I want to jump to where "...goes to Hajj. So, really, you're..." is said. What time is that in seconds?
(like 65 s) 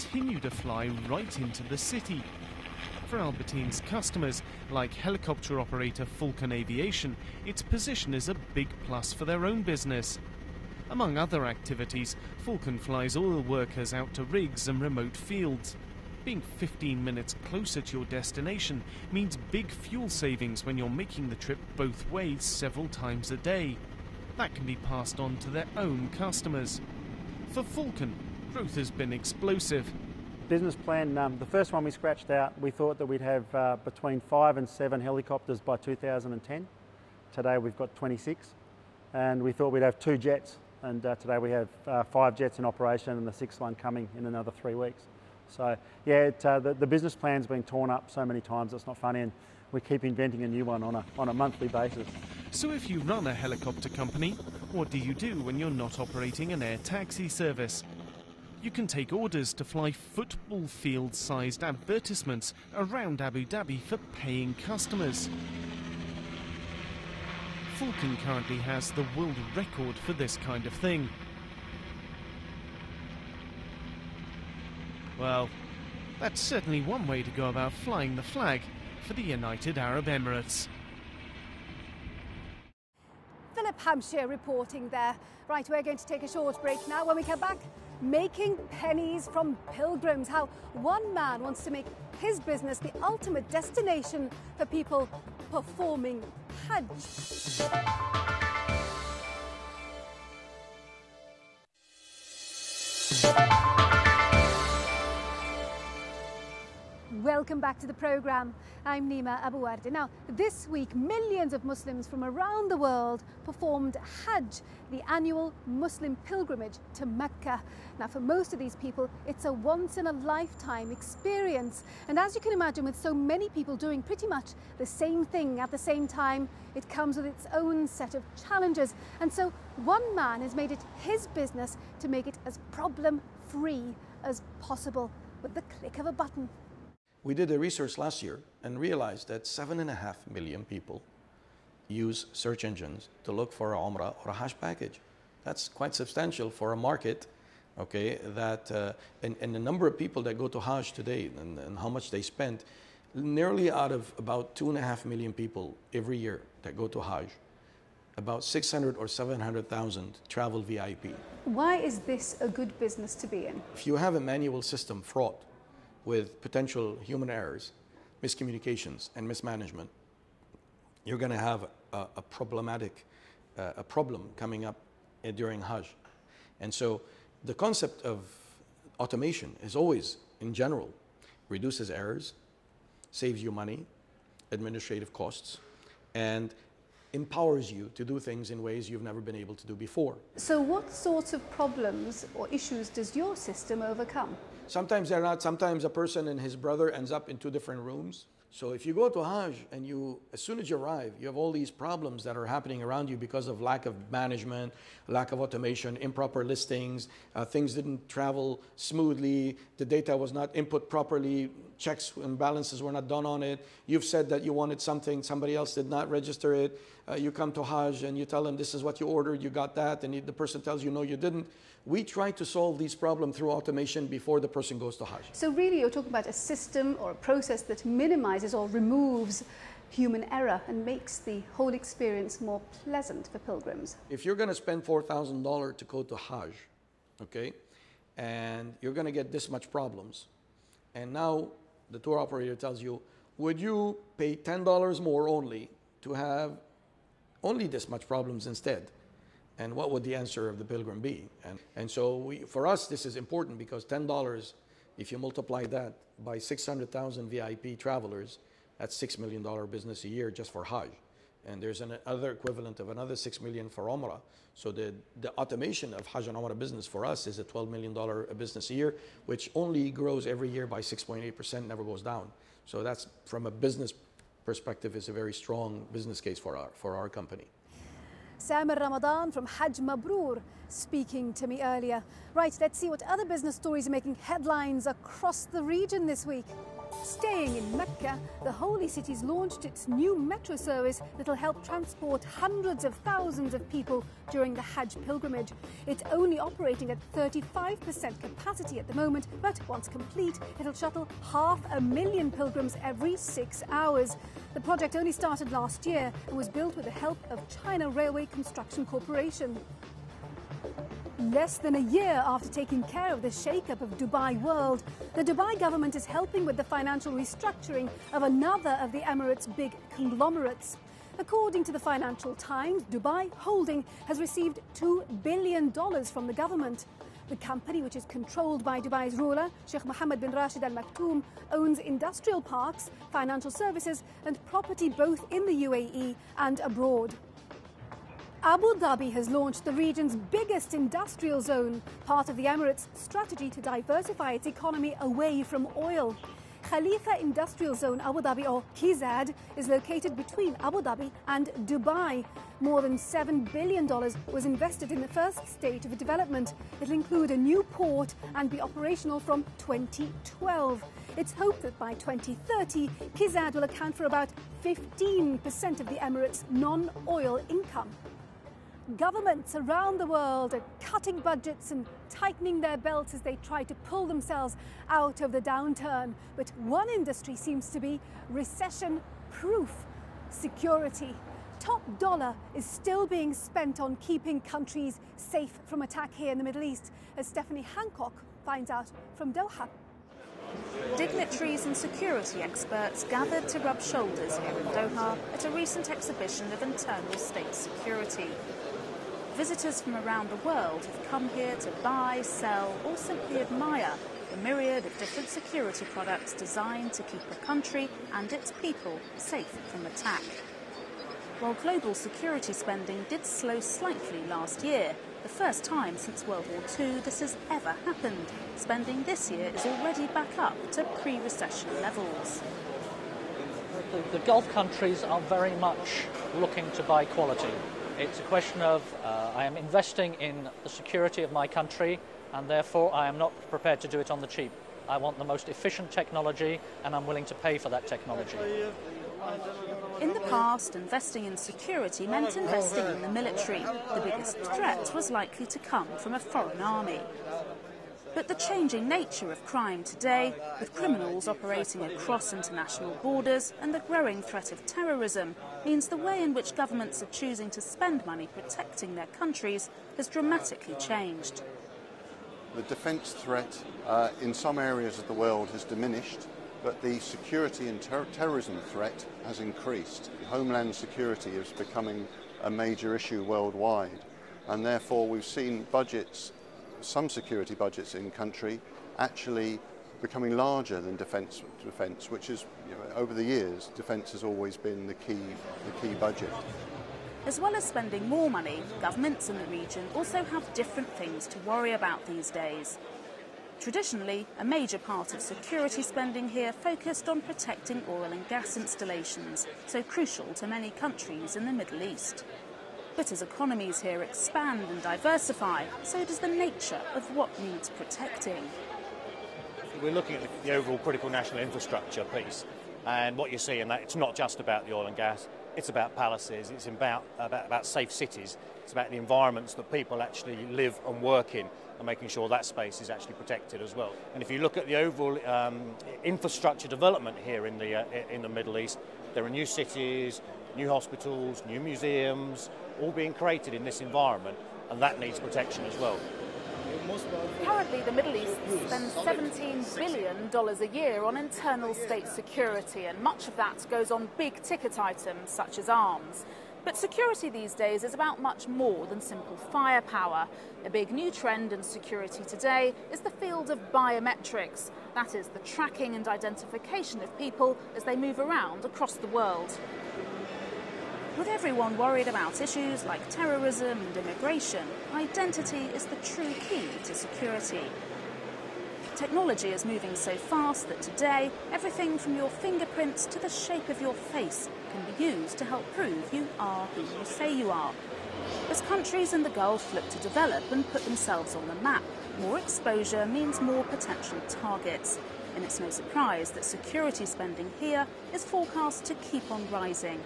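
224 s.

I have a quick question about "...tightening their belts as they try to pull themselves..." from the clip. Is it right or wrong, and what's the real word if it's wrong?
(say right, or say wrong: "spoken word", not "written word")
right.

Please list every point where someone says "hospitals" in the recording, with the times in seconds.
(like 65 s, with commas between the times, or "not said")
530 s.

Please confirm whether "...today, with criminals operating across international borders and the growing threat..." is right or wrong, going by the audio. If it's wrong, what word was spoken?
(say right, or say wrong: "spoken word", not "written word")
right.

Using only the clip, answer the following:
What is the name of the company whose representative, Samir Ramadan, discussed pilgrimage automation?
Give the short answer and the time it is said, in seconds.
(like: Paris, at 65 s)
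Hajj Mabrur, at 279 s.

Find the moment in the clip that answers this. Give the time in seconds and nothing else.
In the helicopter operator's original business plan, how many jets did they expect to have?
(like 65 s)
39 s.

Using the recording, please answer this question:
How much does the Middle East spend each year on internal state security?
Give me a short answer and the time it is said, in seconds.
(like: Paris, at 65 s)
$17 billion, at 538 s.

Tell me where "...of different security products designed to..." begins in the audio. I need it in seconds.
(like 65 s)
404 s.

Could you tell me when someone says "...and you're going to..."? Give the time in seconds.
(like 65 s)
238 s.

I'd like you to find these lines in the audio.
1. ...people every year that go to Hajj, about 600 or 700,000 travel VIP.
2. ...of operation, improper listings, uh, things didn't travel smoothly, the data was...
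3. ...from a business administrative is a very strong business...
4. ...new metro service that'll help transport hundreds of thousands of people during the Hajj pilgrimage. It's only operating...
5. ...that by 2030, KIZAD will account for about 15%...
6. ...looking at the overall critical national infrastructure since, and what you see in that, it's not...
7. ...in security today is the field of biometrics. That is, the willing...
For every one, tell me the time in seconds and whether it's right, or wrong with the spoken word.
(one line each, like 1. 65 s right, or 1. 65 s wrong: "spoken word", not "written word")
1. 155 s right
2. 205 s wrong: "automation", not "operation"
3. 273 s wrong: "perspective", not "administrative"
4. 289 s right
5. 361 s right
6. 509 s wrong: "piece", not "since"
7. 551 s wrong: "tracking", not "willing".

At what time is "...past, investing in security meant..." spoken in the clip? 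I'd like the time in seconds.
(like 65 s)
440 s.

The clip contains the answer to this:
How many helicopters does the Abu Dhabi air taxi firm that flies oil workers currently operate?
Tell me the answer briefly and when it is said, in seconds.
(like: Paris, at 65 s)
26, at 37 s.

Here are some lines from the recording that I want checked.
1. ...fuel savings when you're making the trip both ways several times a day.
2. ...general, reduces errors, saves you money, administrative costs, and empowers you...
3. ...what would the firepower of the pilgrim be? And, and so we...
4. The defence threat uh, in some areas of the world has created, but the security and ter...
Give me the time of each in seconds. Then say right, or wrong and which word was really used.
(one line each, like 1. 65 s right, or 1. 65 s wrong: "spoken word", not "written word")
1. 19 s right
2. 180 s right
3. 249 s wrong: "answer", not "firepower"
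4. 462 s wrong: "diminished", not "created".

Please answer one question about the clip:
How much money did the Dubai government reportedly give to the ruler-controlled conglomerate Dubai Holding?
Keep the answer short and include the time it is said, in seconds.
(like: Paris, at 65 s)
$2 billion, at 324 s.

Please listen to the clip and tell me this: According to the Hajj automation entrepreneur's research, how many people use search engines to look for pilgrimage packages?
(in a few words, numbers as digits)
7.5 million.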